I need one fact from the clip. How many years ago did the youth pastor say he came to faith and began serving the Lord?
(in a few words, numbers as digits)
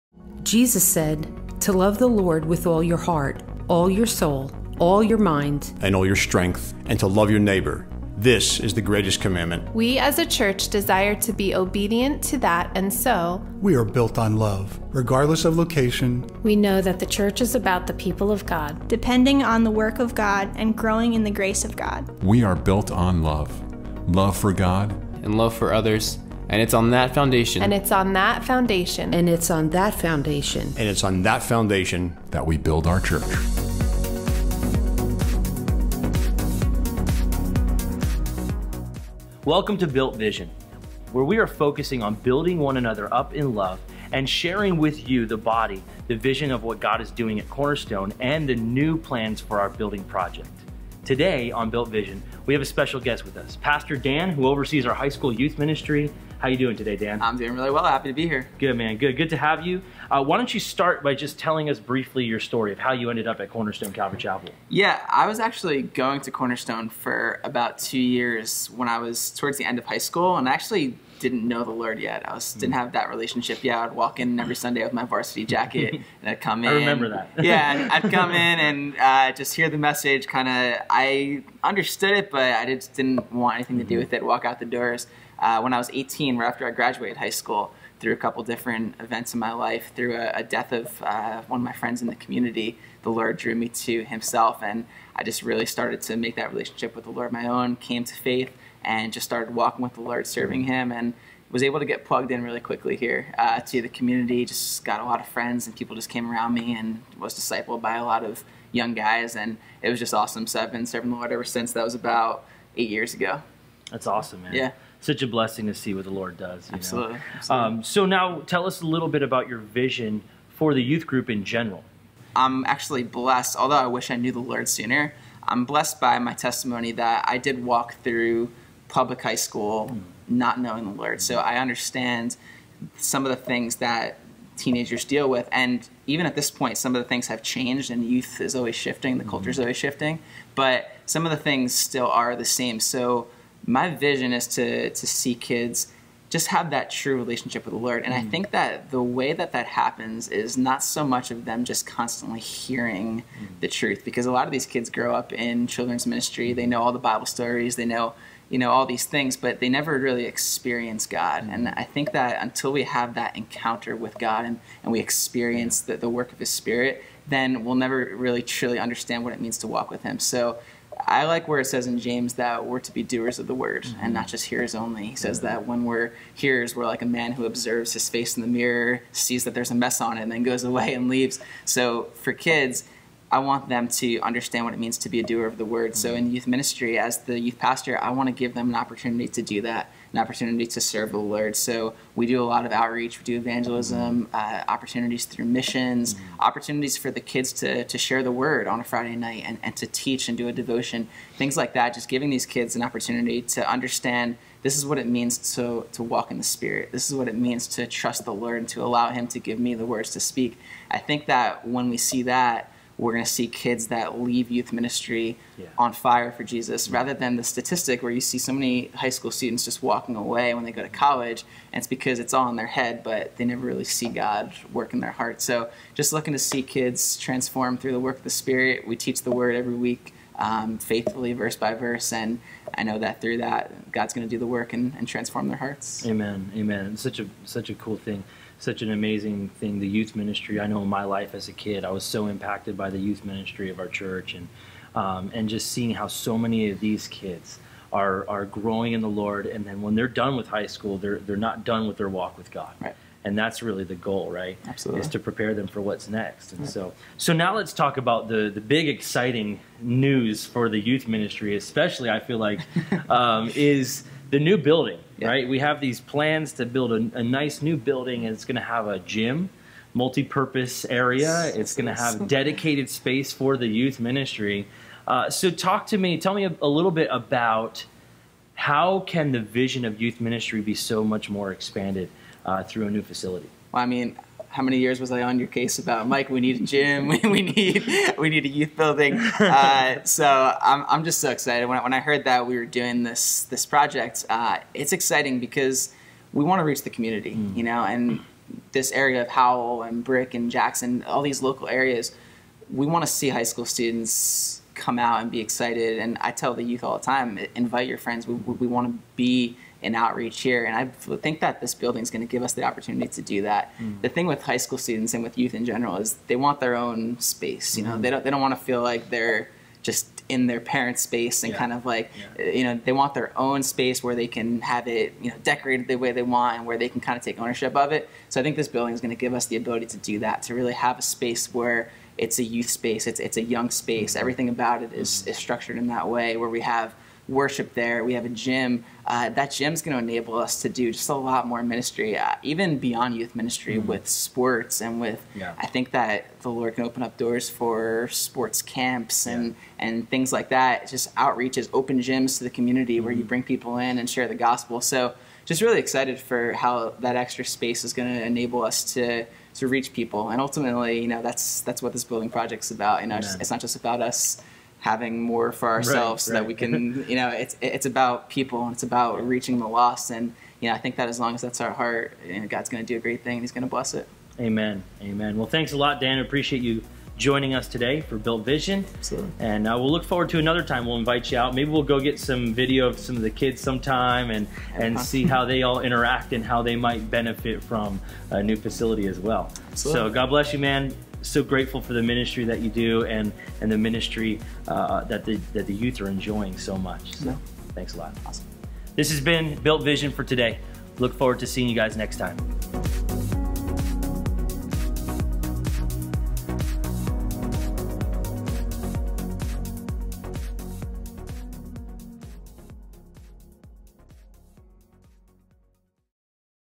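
8.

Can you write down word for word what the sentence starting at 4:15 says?
is to prepare them for what's next and right.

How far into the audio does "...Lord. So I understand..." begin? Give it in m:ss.
2:10.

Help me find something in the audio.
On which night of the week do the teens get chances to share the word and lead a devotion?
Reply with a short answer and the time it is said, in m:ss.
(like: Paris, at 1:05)
Friday, at 3:18.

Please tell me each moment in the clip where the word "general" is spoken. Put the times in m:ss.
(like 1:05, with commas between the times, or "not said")
2:01, 5:15.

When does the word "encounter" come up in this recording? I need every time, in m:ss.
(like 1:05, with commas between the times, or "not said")
2:43.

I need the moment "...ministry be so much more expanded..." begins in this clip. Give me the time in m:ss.
4:40.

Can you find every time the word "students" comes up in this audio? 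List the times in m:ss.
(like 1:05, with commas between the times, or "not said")
3:39, 5:03, 5:14.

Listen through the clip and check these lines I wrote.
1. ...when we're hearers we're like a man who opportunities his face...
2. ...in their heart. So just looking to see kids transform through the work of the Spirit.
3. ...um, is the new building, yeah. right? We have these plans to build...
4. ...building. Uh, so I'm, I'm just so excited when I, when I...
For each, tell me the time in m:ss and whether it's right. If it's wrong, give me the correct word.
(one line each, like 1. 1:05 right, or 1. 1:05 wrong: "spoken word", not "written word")
1. 2:55 wrong: "observes", not "opportunities"
2. 3:44 right
3. 4:23 right
4. 4:48 right.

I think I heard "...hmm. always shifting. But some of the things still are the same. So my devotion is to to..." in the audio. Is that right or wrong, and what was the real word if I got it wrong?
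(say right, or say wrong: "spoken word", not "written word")
wrong: "vision", not "devotion".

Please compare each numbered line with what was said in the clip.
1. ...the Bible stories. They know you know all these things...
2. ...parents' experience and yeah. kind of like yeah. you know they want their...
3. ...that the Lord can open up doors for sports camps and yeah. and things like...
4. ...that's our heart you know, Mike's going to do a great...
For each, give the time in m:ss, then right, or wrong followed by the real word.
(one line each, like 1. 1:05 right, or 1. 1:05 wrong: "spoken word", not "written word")
1. 2:36 right
2. 5:20 wrong: "space", not "experience"
3. 5:45 right
4. 6:11 wrong: "God", not "Mike".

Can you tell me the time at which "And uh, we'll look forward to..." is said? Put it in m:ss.
6:19.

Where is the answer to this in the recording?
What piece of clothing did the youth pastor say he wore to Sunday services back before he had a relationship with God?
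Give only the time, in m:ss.
1:15.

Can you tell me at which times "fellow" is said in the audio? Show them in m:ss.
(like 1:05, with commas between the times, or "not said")
not said.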